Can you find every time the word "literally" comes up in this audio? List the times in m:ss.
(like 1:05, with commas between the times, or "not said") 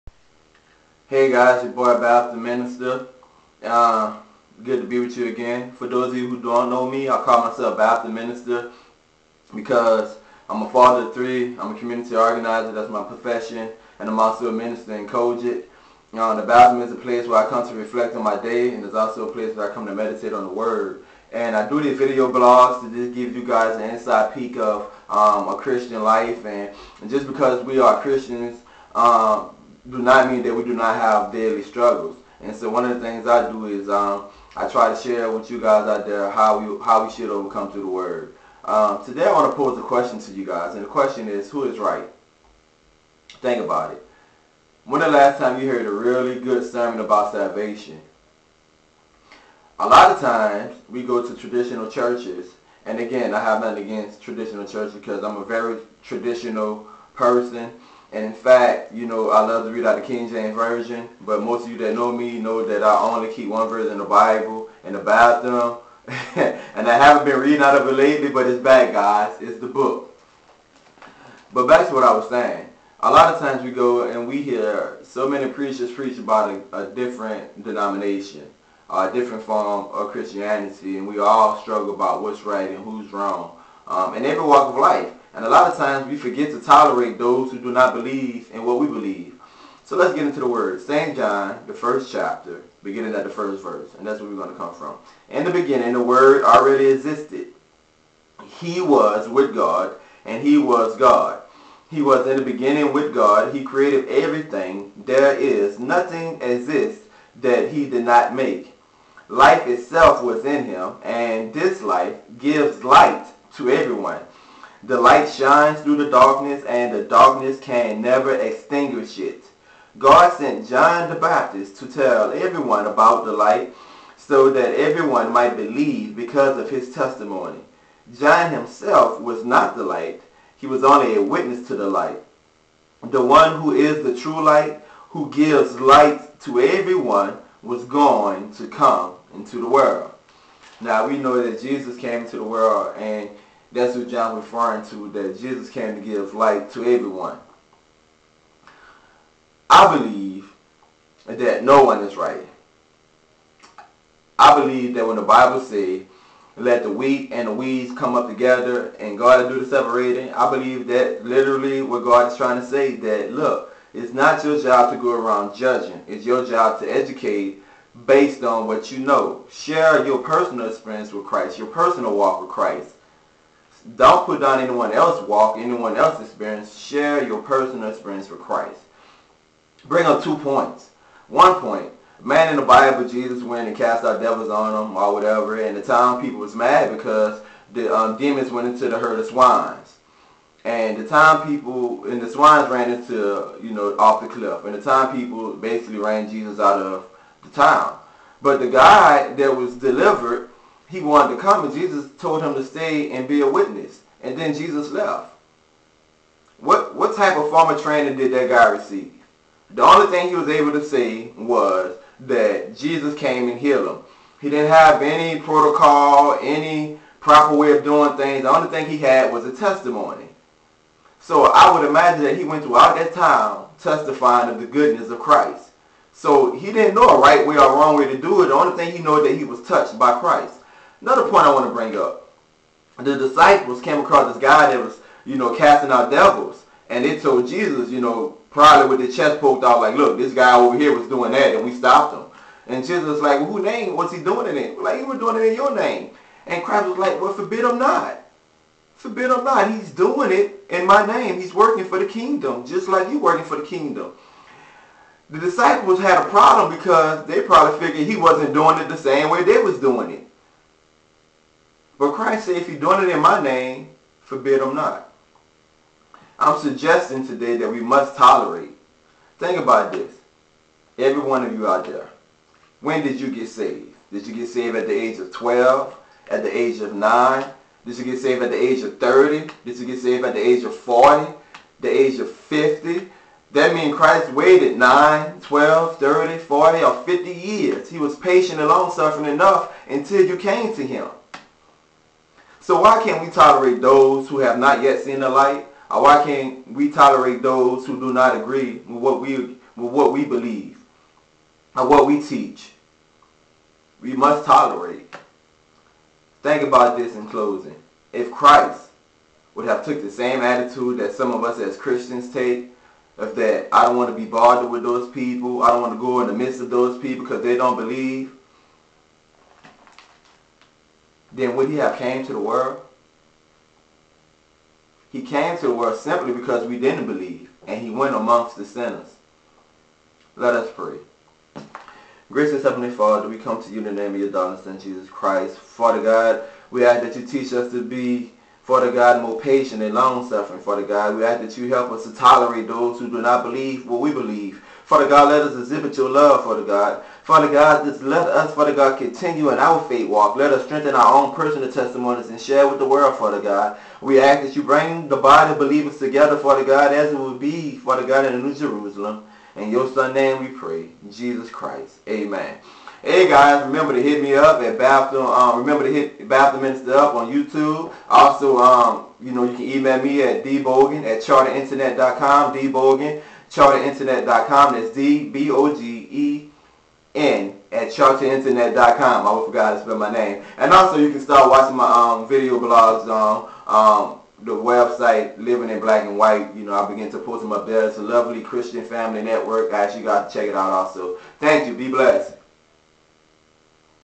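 2:41.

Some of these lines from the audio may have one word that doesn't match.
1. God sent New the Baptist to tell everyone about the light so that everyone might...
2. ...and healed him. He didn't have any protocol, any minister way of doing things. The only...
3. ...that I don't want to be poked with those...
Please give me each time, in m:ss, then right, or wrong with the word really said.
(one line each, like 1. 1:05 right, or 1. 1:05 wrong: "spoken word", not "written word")
1. 1:59 wrong: "John", not "New"
2. 3:33 wrong: "proper", not "minister"
3. 5:13 wrong: "bothered", not "poked".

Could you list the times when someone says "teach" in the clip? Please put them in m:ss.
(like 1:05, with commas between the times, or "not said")
5:02, 5:37.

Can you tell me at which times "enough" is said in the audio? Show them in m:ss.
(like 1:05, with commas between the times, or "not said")
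4:49.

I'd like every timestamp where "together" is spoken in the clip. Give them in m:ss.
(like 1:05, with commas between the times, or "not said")
2:38, 5:55.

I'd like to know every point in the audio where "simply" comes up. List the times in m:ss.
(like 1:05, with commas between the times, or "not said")
5:25.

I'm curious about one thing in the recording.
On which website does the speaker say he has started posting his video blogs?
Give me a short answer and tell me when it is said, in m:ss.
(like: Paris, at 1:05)
Living in Black and White, at 6:25.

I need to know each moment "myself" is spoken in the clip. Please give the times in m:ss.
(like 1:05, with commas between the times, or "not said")
0:07.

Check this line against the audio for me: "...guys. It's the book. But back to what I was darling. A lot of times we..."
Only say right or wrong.
wrong.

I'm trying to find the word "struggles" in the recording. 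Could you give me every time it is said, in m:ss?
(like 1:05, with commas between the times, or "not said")
0:31, 1:21.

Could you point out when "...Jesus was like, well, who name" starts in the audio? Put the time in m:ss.
4:02.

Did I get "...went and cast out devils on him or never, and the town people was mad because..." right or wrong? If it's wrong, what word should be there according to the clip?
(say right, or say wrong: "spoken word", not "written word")
wrong: "whatever", not "never".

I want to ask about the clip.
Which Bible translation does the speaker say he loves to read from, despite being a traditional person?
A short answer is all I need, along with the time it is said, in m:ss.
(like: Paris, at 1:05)
King James Version, at 1:00.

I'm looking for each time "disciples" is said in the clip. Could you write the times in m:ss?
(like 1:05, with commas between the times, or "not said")
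3:53, 4:15.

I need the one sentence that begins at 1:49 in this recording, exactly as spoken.
Life itself was in him, and this life gives light to everyone.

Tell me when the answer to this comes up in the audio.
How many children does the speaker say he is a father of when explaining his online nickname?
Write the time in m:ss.
0:11.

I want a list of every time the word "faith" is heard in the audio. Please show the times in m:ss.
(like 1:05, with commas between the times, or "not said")
5:49.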